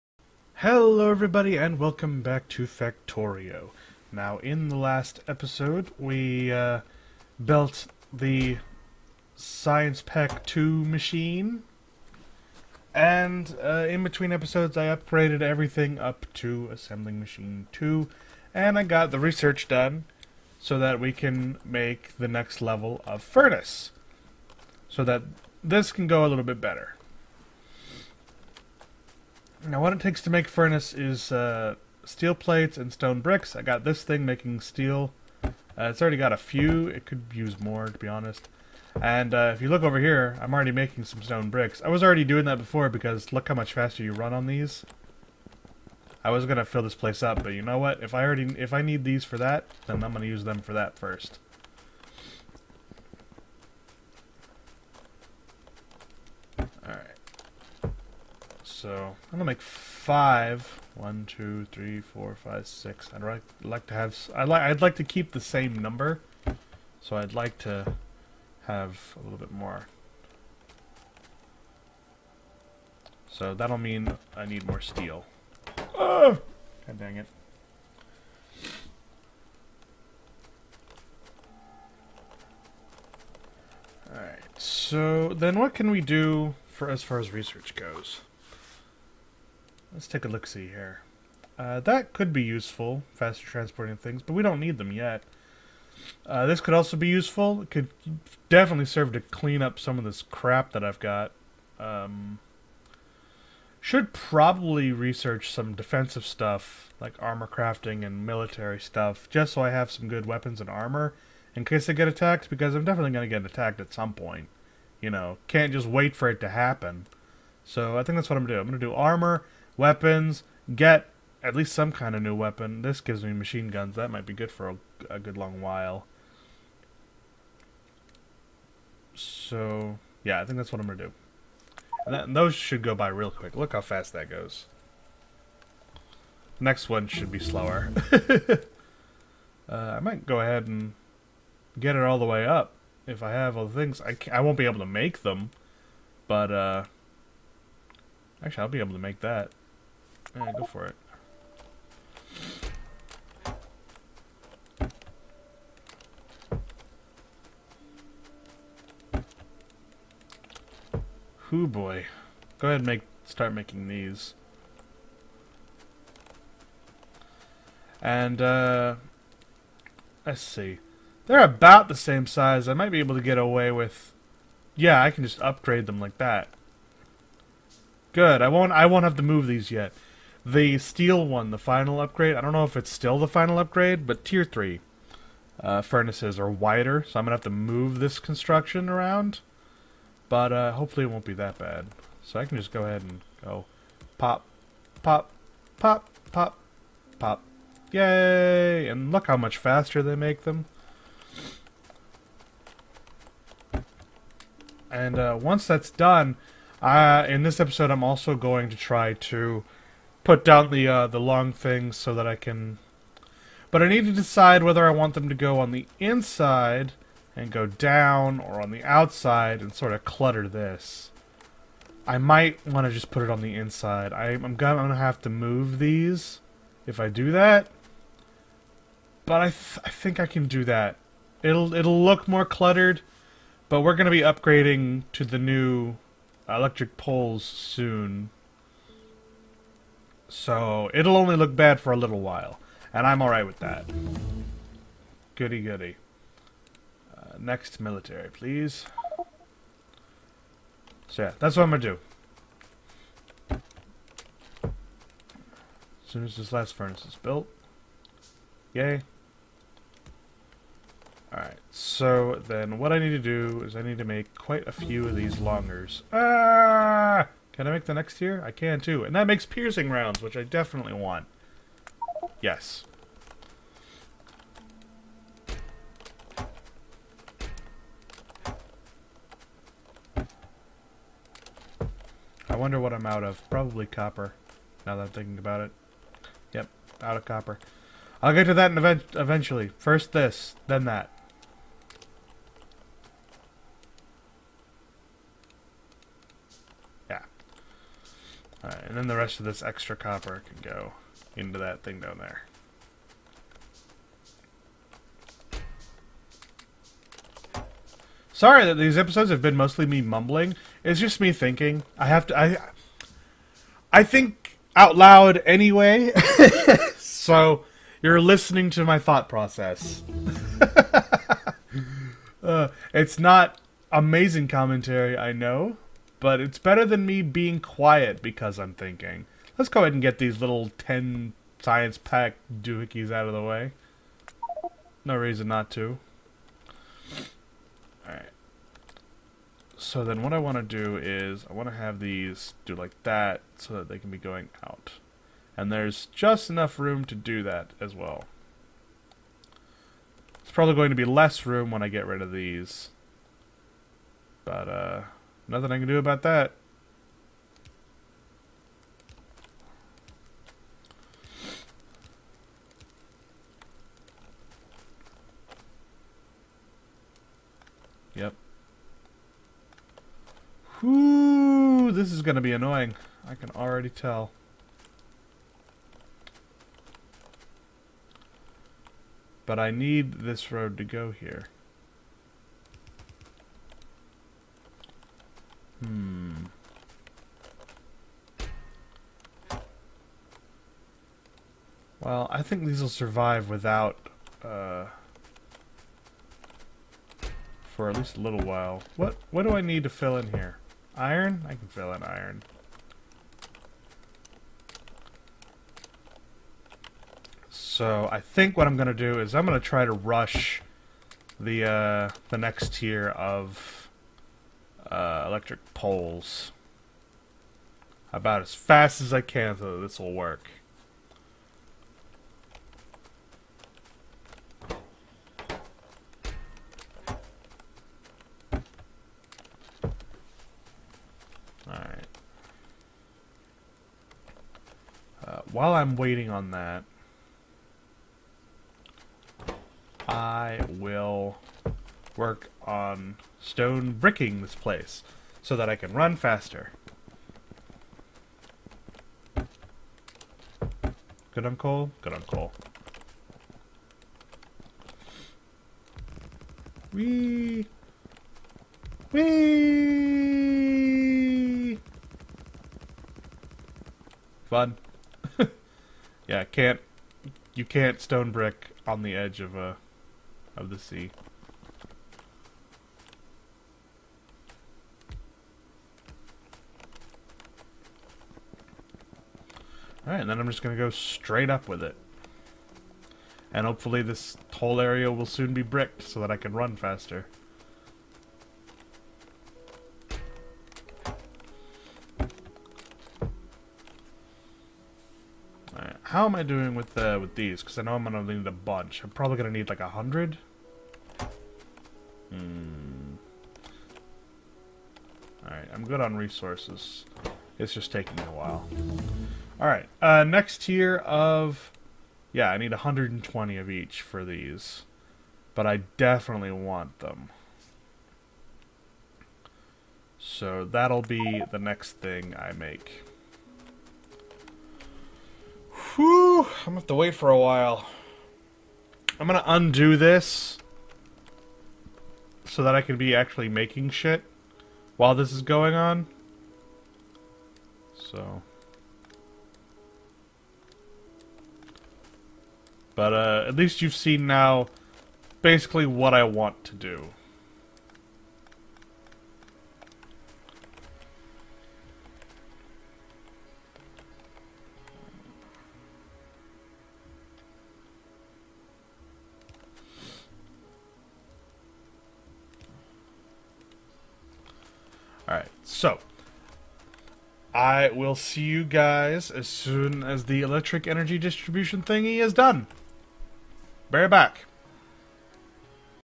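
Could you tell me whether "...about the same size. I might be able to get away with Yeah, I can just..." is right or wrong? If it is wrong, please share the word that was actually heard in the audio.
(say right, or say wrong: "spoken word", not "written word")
right.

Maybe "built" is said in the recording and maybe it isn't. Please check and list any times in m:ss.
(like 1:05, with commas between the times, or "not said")
0:07, 4:17.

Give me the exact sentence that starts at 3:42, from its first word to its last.
I might want to just put it on the inside.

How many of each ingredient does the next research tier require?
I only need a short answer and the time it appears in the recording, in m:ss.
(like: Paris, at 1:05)
120, at 8:32.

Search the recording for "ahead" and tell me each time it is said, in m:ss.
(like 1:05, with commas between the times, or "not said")
2:20, 2:42, 3:12, 5:29.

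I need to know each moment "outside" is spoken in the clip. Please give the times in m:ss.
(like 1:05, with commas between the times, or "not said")
3:38.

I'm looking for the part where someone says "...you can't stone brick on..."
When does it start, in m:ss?
7:47.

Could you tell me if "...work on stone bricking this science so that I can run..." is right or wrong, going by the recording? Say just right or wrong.
wrong.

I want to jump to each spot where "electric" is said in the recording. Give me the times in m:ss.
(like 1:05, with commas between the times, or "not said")
3:56, 6:55, 9:30.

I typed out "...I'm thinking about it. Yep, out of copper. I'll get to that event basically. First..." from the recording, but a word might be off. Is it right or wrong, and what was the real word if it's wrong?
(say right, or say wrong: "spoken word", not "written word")
wrong: "eventually", not "basically".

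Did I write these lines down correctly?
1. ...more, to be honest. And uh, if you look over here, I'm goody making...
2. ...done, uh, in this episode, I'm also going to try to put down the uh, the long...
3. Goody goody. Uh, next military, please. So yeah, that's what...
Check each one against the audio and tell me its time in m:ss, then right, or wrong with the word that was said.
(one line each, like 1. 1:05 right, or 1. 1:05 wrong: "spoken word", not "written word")
1. 0:37 wrong: "already", not "goody"
2. 3:25 right
3. 4:05 right.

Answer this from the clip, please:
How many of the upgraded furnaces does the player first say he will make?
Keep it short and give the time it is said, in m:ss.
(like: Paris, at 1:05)
5, at 0:59.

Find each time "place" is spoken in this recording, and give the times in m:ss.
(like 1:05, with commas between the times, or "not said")
0:46, 7:24.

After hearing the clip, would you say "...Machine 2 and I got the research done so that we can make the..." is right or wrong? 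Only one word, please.
right.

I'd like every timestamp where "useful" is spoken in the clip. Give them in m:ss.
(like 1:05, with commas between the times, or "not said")
1:32, 1:37.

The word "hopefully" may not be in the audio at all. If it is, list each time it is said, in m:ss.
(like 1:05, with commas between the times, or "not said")
3:10, 8:03.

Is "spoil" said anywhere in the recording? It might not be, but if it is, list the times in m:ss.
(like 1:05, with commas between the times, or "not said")
not said.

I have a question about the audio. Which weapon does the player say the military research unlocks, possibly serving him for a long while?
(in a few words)
Machine guns.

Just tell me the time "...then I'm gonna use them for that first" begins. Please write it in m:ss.
0:49.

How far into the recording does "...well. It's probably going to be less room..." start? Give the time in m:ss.
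5:47.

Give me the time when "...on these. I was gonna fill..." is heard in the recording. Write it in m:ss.
0:44.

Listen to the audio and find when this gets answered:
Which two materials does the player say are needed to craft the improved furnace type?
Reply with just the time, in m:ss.
0:32.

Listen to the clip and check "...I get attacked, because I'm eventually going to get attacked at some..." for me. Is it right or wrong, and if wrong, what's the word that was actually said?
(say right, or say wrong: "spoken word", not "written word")
wrong: "definitely", not "eventually".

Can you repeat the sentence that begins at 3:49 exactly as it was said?
But I, th I think I can do that.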